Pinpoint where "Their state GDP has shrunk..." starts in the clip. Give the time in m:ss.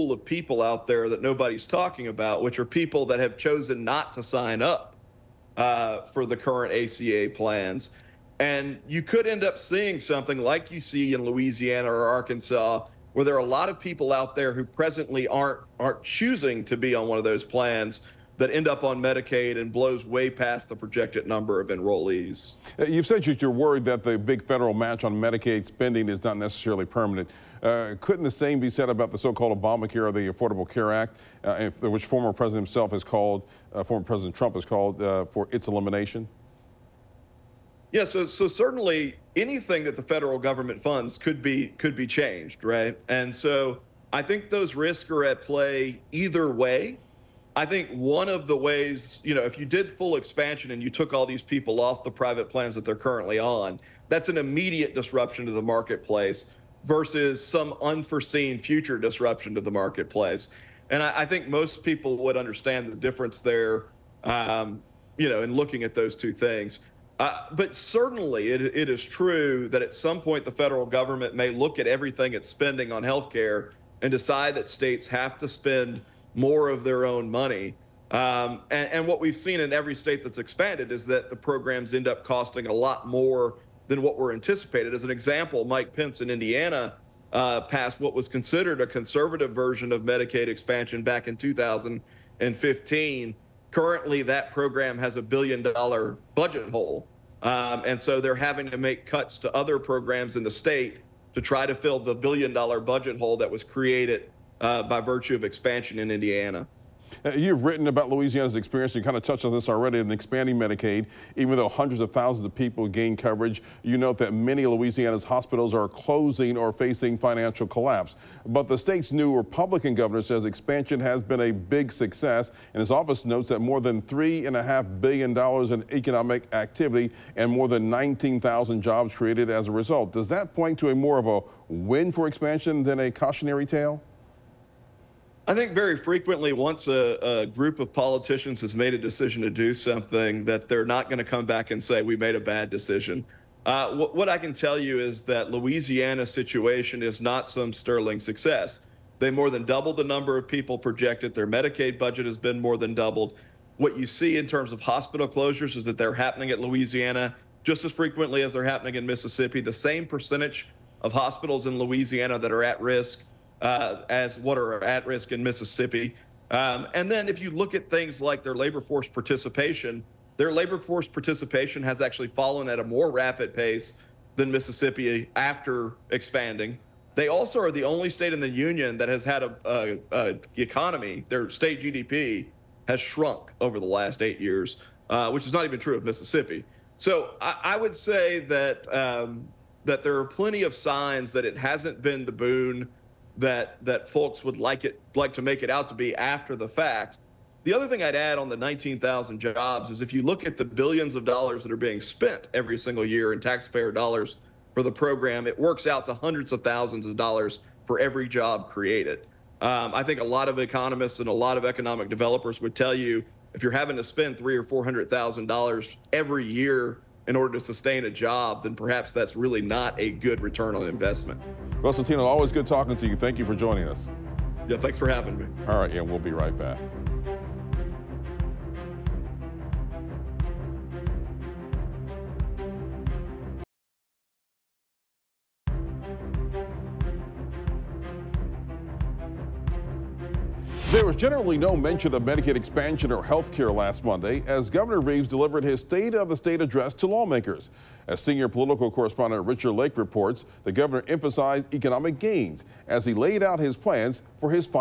3:01.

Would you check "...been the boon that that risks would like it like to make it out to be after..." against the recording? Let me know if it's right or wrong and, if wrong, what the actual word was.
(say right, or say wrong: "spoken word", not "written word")
wrong: "folks", not "risks".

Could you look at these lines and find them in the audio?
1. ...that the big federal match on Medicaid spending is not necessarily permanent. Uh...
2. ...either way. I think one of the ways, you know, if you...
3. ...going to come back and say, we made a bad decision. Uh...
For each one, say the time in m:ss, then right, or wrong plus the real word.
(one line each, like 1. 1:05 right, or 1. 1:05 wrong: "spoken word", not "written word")
1. 0:23 right
2. 0:46 right
3. 2:21 right.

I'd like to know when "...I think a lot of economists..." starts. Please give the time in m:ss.
3:29.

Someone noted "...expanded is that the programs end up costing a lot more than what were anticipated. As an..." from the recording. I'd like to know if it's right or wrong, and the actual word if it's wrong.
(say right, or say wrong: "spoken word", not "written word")
right.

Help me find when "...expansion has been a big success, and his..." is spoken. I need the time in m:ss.
2:00.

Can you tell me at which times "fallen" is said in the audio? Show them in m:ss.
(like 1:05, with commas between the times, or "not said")
2:52.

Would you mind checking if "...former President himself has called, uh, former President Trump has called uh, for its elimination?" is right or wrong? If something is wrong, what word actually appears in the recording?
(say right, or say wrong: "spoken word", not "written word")
right.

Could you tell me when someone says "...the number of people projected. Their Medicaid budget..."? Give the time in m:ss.
2:29.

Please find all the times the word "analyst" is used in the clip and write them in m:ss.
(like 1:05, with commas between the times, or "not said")
not said.